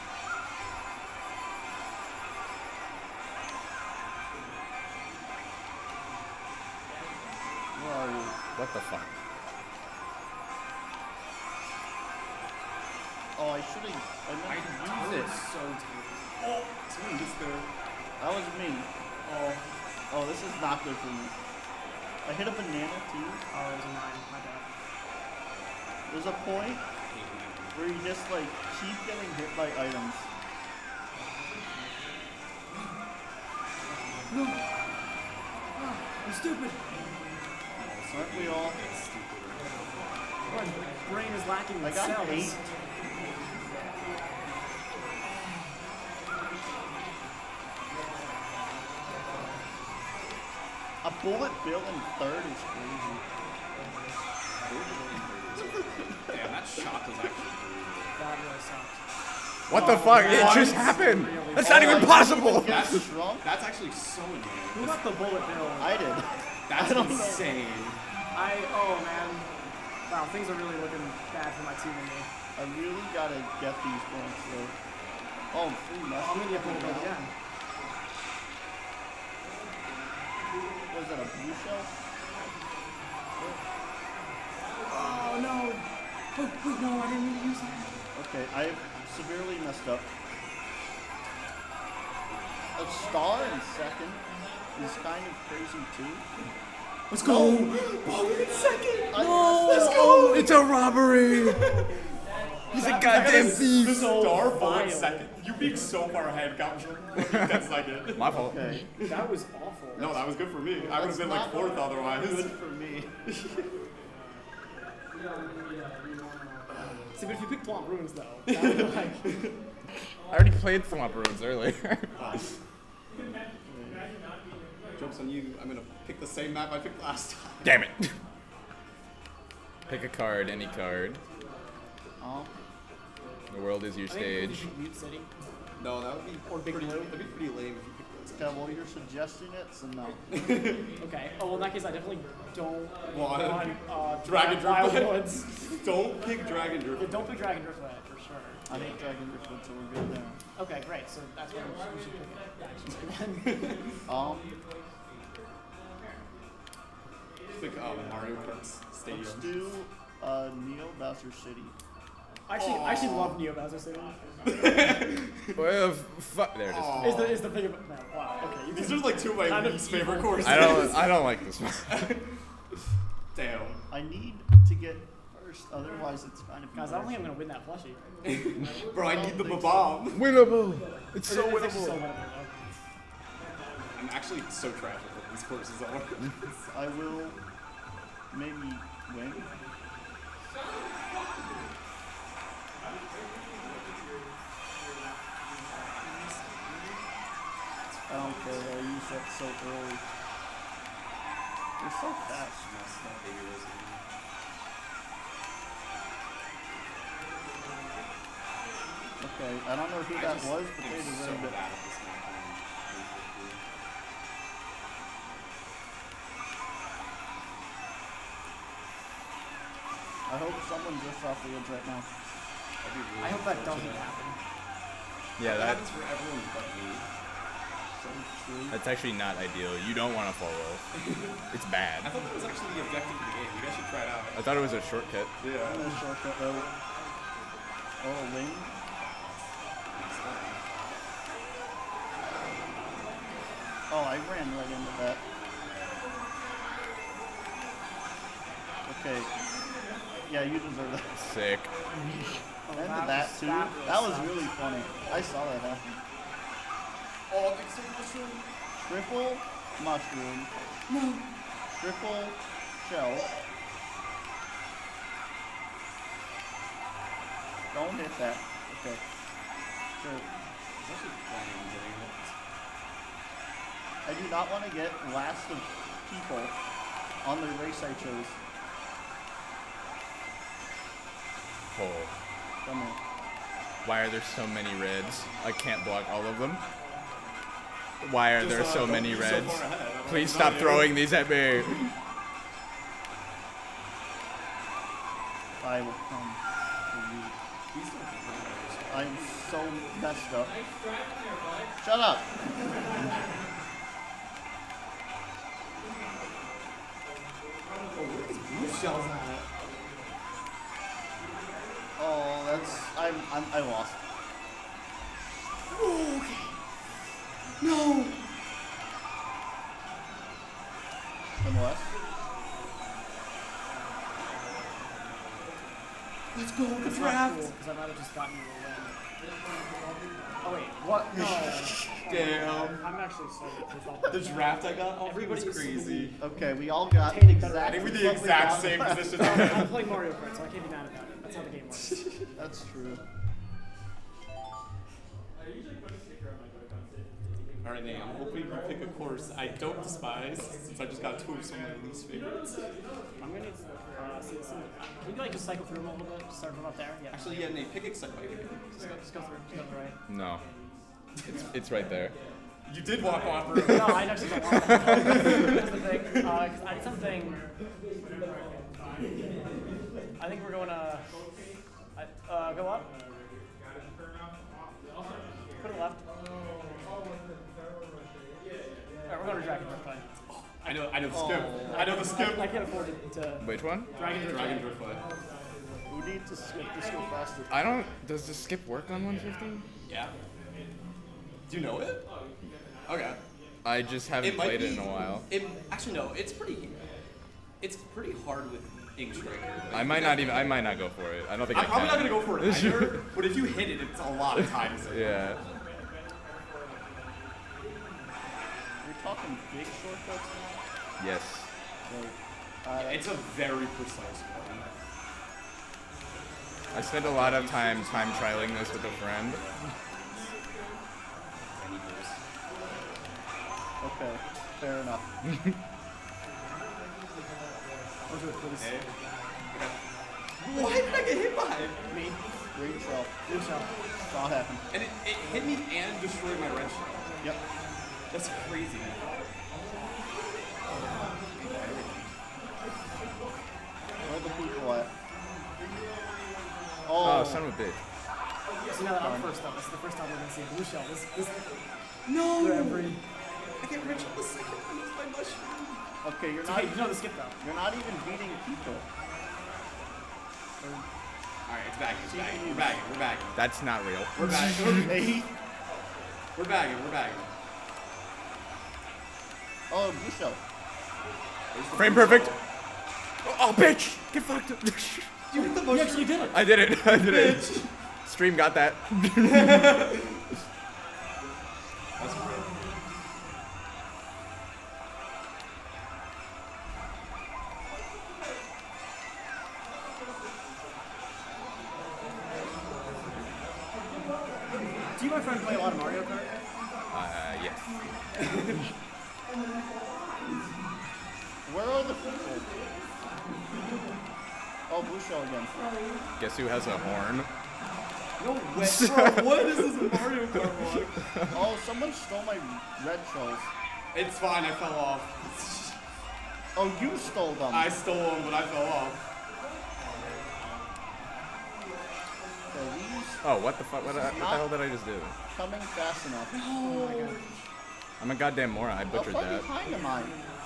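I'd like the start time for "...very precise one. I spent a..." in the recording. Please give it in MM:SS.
06:53.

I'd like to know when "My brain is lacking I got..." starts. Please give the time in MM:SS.
00:40.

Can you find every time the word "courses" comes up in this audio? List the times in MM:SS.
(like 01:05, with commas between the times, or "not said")
02:50, 03:05, 05:48.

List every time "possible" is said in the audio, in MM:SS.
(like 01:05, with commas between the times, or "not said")
01:02.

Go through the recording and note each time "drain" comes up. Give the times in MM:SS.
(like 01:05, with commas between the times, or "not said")
not said.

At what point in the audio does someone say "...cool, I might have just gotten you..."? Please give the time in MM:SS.
05:27.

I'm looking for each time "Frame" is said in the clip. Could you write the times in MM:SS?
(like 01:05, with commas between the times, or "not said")
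07:51.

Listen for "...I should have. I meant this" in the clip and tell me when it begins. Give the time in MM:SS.
00:13.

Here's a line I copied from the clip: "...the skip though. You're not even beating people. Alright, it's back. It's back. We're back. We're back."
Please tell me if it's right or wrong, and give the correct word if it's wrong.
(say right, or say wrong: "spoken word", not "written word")
right.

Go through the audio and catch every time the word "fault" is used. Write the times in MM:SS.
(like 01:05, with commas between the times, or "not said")
01:48.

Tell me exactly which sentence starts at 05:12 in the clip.
Oh, that's I'm, I'm I lost.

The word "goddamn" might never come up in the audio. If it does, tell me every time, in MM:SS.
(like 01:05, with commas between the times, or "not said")
01:43, 08:48.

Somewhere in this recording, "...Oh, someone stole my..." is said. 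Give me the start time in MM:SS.
08:31.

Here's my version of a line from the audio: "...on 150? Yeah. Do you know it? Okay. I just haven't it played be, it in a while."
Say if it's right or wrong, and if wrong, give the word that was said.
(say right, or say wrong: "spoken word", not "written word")
right.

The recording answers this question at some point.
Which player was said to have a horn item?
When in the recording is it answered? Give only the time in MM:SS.
08:26.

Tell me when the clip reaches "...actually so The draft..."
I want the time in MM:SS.
05:32.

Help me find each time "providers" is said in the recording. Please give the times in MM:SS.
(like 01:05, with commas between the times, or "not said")
not said.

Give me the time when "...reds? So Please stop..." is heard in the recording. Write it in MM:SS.
04:49.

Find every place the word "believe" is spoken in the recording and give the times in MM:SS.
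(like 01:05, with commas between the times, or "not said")
not said.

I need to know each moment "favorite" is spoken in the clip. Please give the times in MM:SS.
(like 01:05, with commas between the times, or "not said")
02:49, 05:52.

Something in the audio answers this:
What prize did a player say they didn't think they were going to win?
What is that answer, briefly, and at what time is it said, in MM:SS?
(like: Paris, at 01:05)
plushie, at 02:57.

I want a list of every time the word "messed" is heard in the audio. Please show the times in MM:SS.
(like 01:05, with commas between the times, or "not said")
01:29, 05:00.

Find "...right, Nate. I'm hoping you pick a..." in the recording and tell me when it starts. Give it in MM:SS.
05:47.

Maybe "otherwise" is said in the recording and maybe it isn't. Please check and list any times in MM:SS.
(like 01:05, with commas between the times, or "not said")
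01:51, 02:55.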